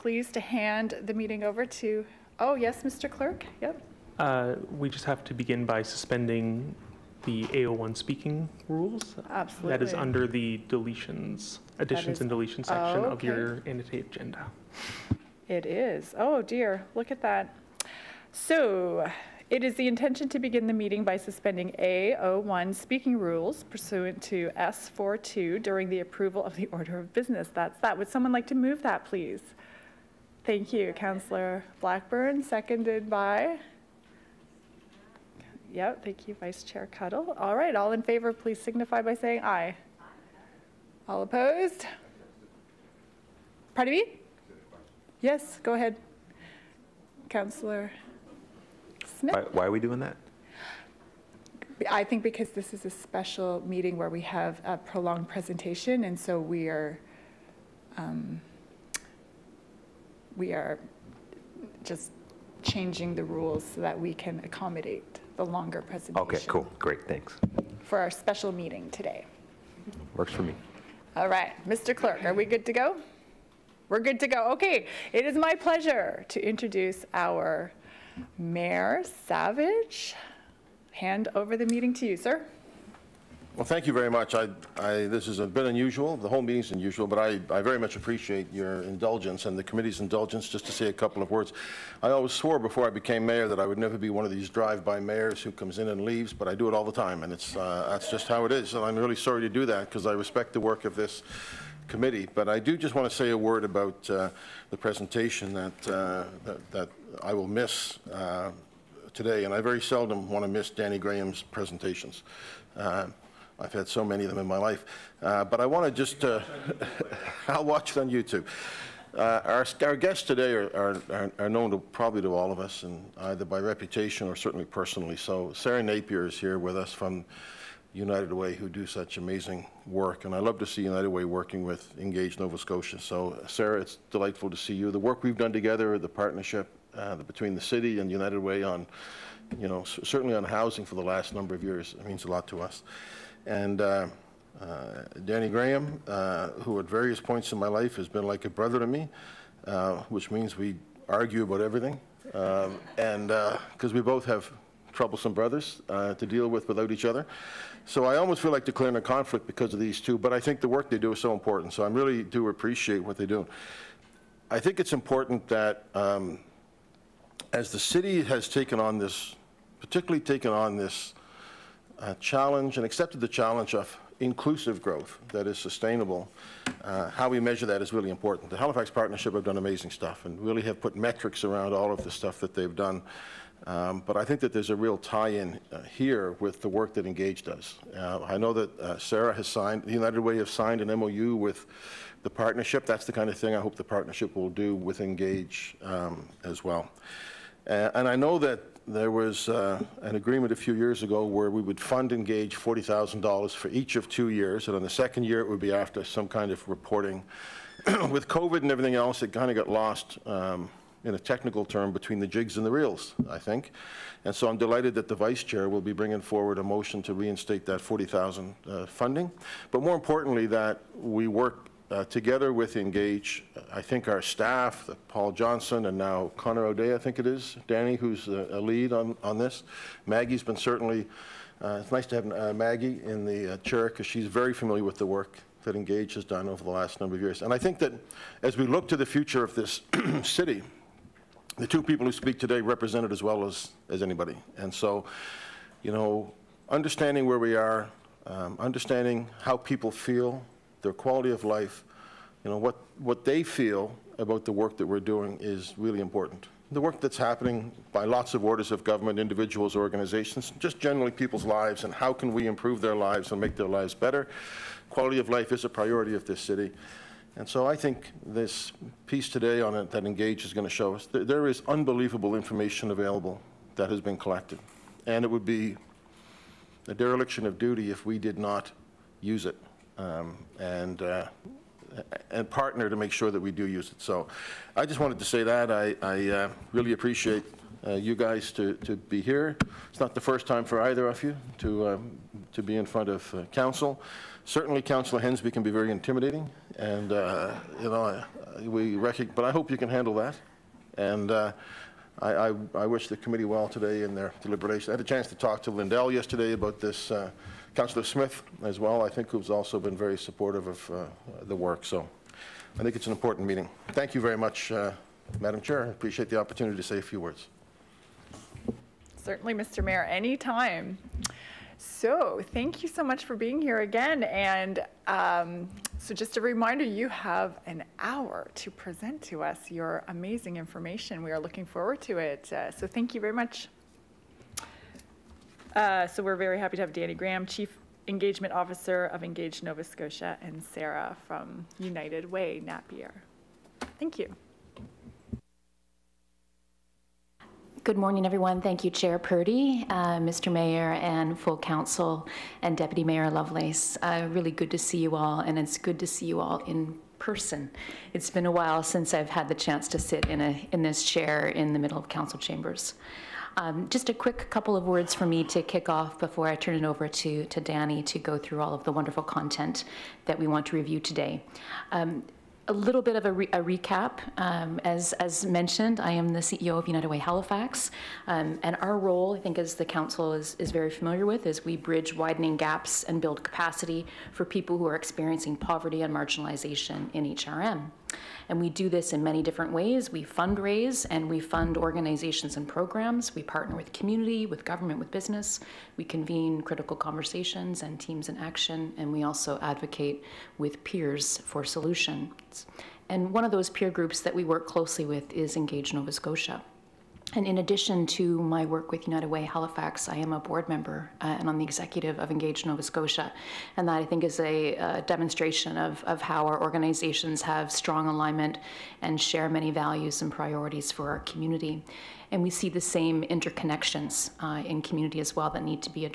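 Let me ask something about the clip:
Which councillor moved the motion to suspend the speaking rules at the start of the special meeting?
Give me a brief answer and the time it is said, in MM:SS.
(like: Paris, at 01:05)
Blackburn, at 00:30.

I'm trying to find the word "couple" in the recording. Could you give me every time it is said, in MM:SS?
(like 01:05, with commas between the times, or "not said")
01:30, 06:04.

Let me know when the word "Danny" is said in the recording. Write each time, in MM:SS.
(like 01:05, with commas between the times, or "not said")
01:50, 02:25, 03:47, 05:36, 06:07.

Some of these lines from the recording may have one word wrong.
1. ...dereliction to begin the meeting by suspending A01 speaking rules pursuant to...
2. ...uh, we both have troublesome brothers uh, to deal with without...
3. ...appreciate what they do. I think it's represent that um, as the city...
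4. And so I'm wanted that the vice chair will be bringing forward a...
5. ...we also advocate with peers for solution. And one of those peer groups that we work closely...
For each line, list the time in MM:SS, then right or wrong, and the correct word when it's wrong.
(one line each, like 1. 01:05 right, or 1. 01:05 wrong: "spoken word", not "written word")
1. 00:19 wrong: "intention", not "dereliction"
2. 02:33 right
3. 02:42 wrong: "important", not "represent"
4. 03:34 wrong: "delighted", not "wanted"
5. 06:39 right.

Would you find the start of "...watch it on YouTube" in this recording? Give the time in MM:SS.
01:57.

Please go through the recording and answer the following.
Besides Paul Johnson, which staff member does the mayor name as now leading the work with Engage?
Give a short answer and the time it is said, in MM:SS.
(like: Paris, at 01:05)
Connor O'Day, at 03:46.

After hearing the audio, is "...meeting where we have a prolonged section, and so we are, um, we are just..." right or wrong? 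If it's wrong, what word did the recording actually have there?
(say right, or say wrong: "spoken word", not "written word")
wrong: "presentation", not "section".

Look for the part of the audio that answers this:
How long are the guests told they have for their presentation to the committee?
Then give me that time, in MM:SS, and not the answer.
05:27.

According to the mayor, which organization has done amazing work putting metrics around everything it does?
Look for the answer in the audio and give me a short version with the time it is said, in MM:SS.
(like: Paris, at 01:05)
The Halifax Partnership, at 02:58.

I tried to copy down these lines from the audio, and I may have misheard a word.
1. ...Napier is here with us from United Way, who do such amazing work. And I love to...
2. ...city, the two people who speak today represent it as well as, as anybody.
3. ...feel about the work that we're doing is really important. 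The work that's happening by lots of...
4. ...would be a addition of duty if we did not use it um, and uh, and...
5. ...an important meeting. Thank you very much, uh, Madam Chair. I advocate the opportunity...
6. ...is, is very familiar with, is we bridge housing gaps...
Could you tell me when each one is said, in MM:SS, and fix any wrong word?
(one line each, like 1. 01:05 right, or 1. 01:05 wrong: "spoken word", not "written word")
1. 02:05 right
2. 04:00 right
3. 04:13 right
4. 04:35 wrong: "dereliction", not "addition"
5. 05:13 wrong: "appreciate", not "advocate"
6. 06:20 wrong: "widening", not "housing".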